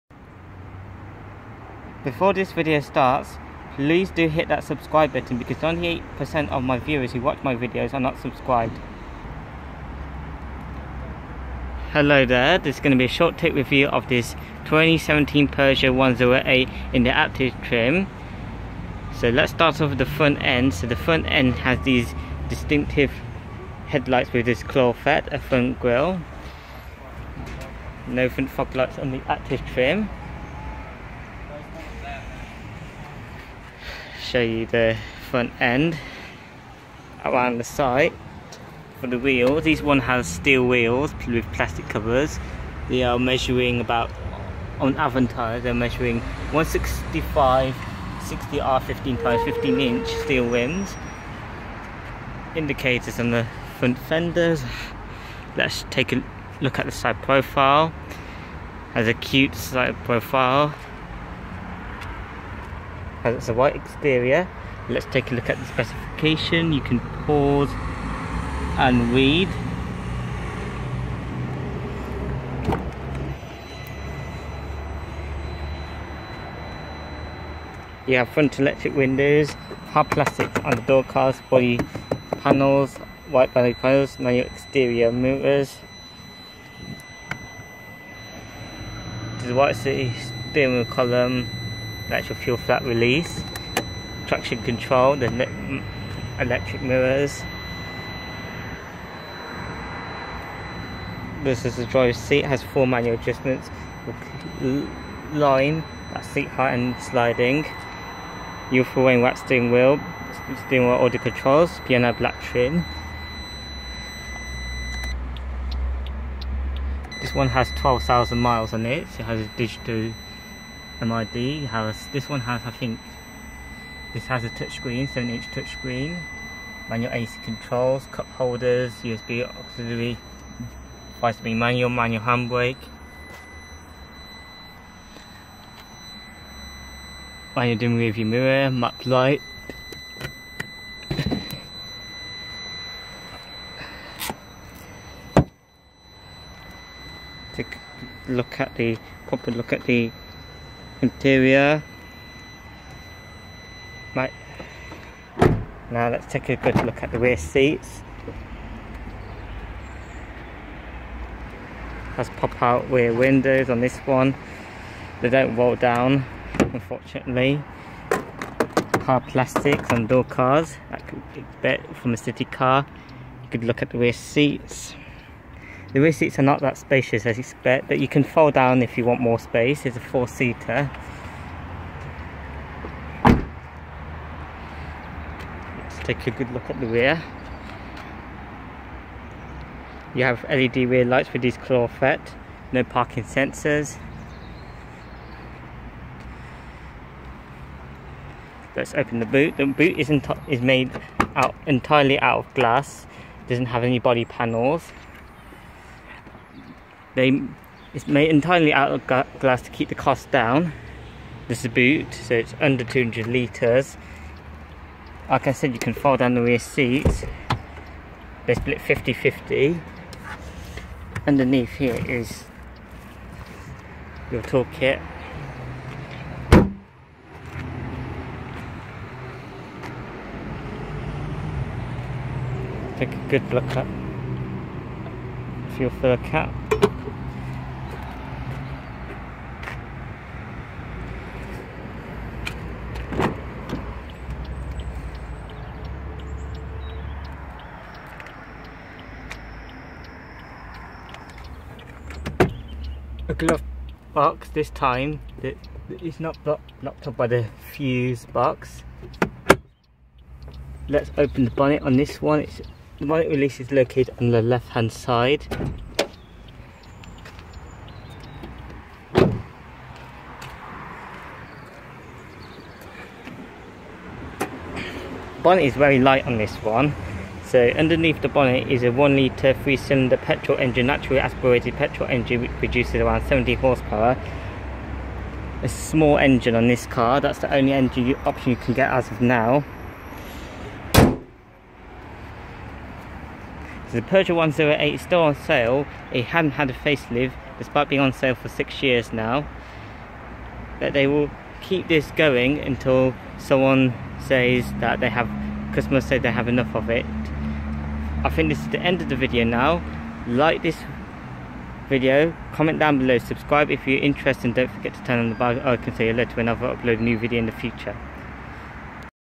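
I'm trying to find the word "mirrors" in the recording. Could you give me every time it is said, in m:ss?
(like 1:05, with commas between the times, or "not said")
1:25, 1:36, 2:18.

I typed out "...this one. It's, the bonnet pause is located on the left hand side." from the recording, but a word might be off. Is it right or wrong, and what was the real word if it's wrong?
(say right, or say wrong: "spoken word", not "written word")
wrong: "release", not "pause".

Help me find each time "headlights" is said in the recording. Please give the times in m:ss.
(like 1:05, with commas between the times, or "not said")
0:23.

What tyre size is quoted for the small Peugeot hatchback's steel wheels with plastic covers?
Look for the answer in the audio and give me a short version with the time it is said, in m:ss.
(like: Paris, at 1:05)
165/60 R15, at 0:46.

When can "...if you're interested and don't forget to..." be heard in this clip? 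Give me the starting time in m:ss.
5:13.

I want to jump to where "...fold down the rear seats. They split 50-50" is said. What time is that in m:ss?
3:35.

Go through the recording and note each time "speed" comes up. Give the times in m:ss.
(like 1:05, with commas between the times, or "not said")
2:11.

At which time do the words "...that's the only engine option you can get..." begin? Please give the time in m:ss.
4:47.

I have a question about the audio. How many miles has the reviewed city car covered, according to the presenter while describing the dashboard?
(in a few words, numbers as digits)
12,000.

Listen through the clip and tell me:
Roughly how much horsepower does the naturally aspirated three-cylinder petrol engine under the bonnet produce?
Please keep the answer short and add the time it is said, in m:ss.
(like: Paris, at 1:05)
70, at 4:43.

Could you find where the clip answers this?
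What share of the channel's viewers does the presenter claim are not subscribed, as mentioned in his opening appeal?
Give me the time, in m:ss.
0:05.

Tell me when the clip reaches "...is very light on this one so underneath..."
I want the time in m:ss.
4:35.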